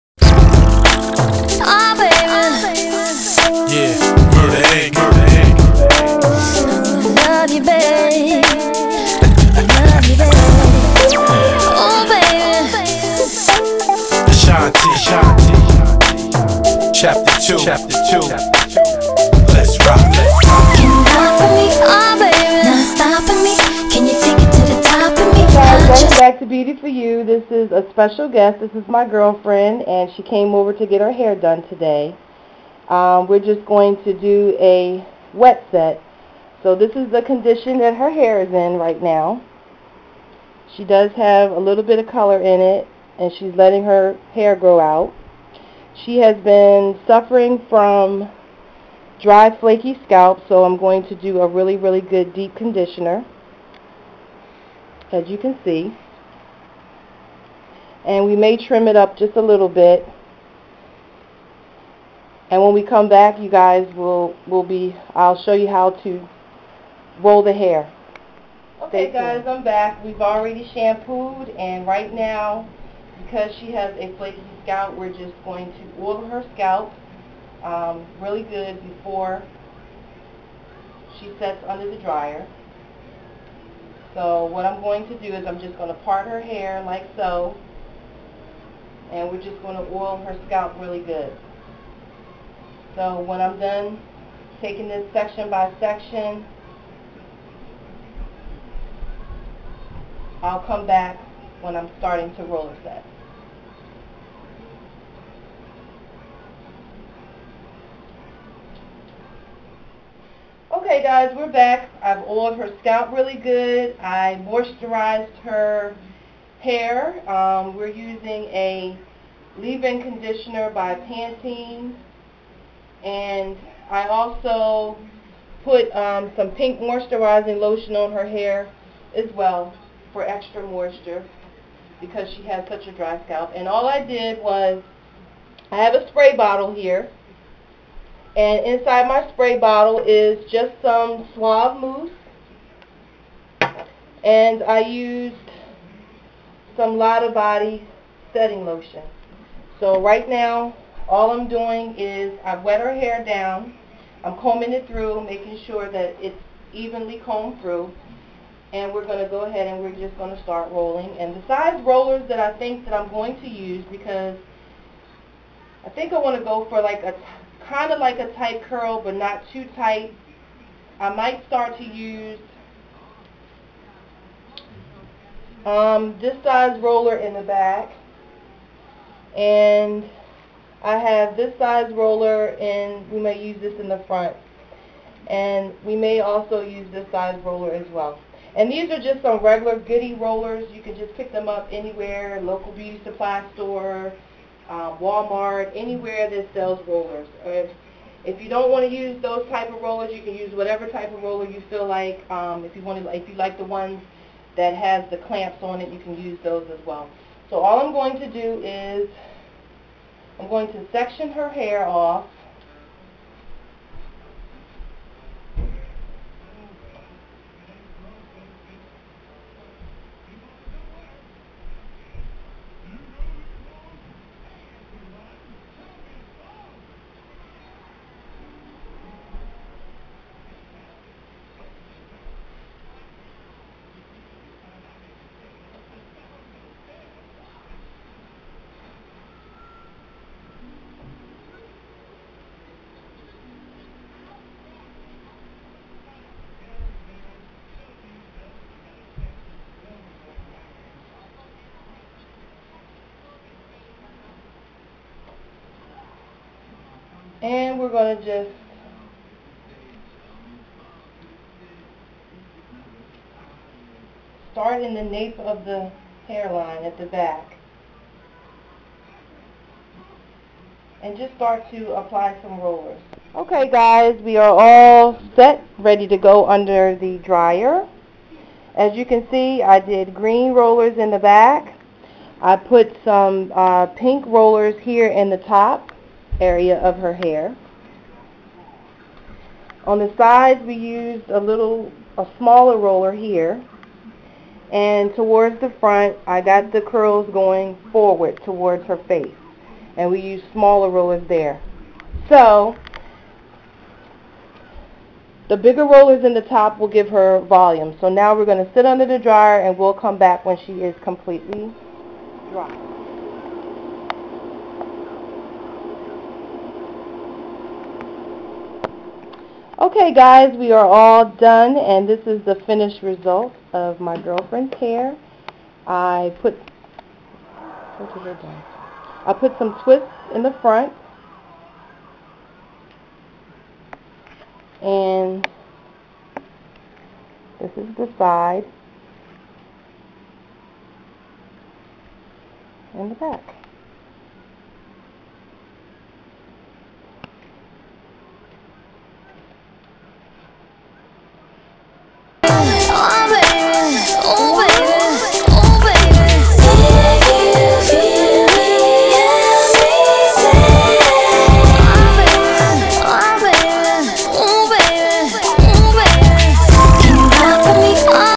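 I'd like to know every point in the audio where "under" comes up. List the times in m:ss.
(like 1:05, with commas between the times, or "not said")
1:21, 4:36, 5:08.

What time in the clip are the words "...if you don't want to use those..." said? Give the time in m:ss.
3:18.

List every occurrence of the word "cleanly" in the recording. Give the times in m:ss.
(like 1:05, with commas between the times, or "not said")
not said.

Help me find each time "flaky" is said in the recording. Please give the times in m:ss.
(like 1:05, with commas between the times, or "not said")
0:49, 1:14.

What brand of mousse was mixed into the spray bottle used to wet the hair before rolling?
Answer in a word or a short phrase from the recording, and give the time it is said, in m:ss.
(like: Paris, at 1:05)
Suave, at 2:21.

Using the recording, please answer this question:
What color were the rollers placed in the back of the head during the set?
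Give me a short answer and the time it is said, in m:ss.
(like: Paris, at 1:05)
Green, at 4:40.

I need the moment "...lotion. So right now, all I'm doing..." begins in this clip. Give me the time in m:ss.
2:28.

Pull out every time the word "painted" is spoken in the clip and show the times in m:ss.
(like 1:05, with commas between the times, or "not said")
not said.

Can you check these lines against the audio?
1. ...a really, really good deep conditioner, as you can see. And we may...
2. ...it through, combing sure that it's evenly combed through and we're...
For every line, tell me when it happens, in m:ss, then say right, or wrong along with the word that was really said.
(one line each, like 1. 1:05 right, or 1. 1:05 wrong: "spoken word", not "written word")
1. 0:51 right
2. 2:34 wrong: "making", not "combing".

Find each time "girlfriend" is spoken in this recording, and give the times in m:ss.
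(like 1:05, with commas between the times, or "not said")
0:29, 5:24.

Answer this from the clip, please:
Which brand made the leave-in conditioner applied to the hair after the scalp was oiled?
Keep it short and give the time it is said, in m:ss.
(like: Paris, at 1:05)
Pantene, at 2:00.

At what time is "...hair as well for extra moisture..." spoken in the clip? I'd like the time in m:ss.
2:08.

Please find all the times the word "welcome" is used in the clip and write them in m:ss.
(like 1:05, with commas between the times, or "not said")
0:25.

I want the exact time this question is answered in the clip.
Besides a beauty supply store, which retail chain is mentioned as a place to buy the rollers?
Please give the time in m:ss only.
3:14.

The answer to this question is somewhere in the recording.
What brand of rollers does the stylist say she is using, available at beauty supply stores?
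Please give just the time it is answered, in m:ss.
3:09.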